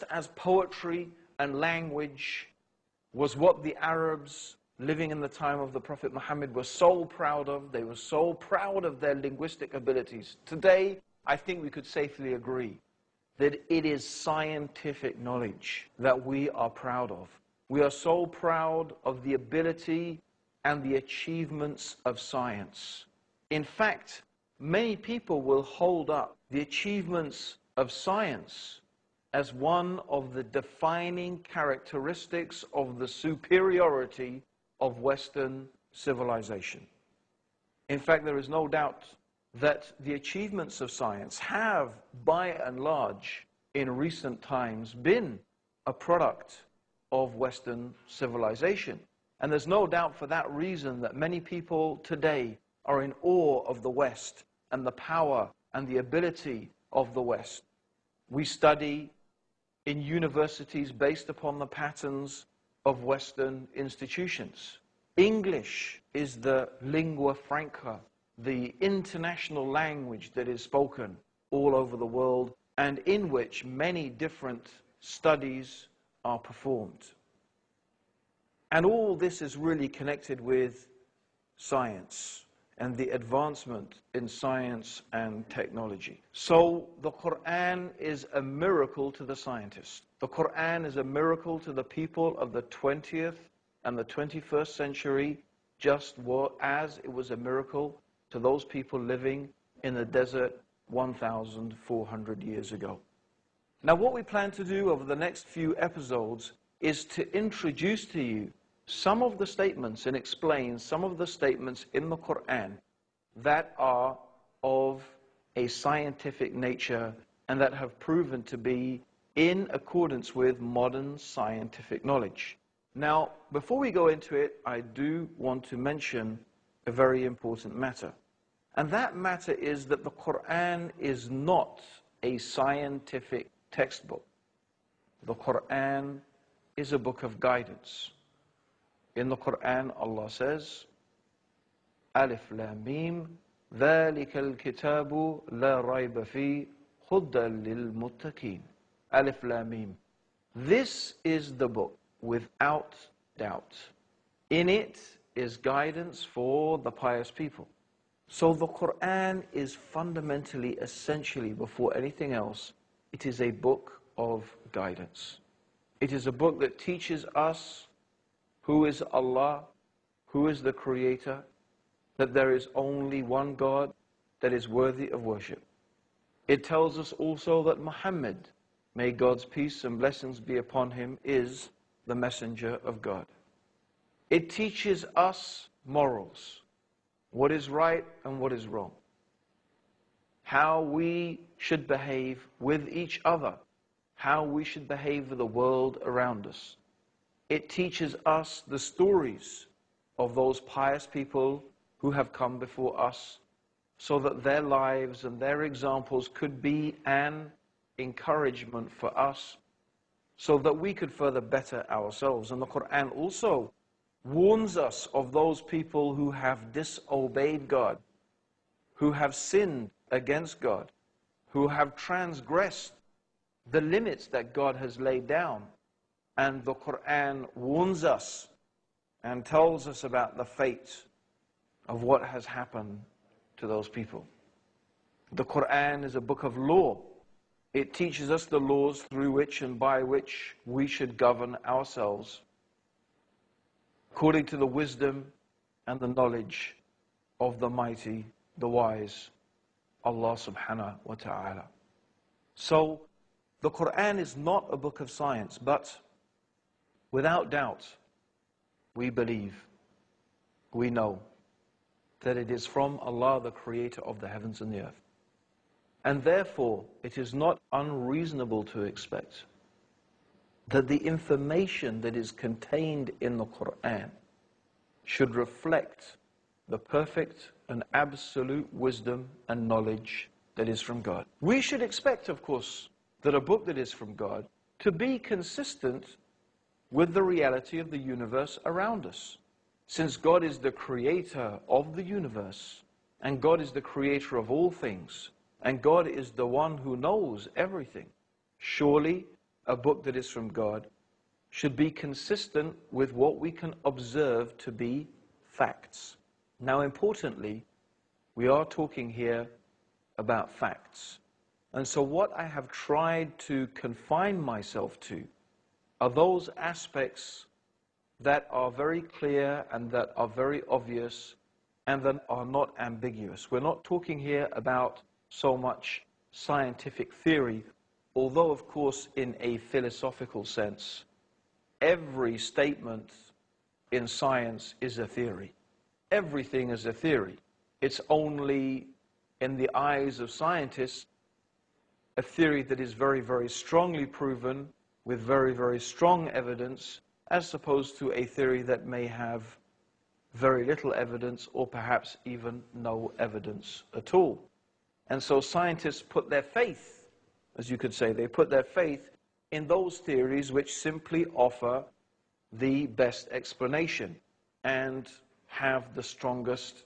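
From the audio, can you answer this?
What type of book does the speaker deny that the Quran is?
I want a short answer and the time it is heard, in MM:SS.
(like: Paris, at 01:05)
scientific textbook, at 02:12.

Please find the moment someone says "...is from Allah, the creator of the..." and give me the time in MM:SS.
04:22.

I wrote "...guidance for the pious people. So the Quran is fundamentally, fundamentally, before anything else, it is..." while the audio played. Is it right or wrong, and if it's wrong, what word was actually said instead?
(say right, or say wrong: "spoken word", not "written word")
wrong: "essentially", not "fundamentally".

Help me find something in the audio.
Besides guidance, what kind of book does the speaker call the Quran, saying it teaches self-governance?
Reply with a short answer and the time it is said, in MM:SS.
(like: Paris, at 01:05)
a book of law, at 03:56.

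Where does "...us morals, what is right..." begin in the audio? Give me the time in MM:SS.
03:05.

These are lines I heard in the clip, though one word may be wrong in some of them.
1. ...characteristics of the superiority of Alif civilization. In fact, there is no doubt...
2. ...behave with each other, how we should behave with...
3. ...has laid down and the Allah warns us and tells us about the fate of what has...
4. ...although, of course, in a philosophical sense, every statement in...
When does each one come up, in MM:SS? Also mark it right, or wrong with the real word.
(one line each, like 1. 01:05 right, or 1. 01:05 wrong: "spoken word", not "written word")
1. 00:31 wrong: "Western", not "Alif"
2. 03:11 right
3. 03:44 wrong: "Quran", not "Allah"
4. 05:28 right.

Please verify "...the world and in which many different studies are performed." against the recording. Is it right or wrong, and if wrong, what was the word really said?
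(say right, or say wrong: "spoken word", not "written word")
right.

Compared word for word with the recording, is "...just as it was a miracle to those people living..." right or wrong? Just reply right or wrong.
right.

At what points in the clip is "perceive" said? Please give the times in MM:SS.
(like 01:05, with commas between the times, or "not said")
not said.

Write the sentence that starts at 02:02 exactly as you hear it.
Now, before we go into it, I do want to mention a very important matter.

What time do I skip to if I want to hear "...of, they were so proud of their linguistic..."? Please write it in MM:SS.
00:07.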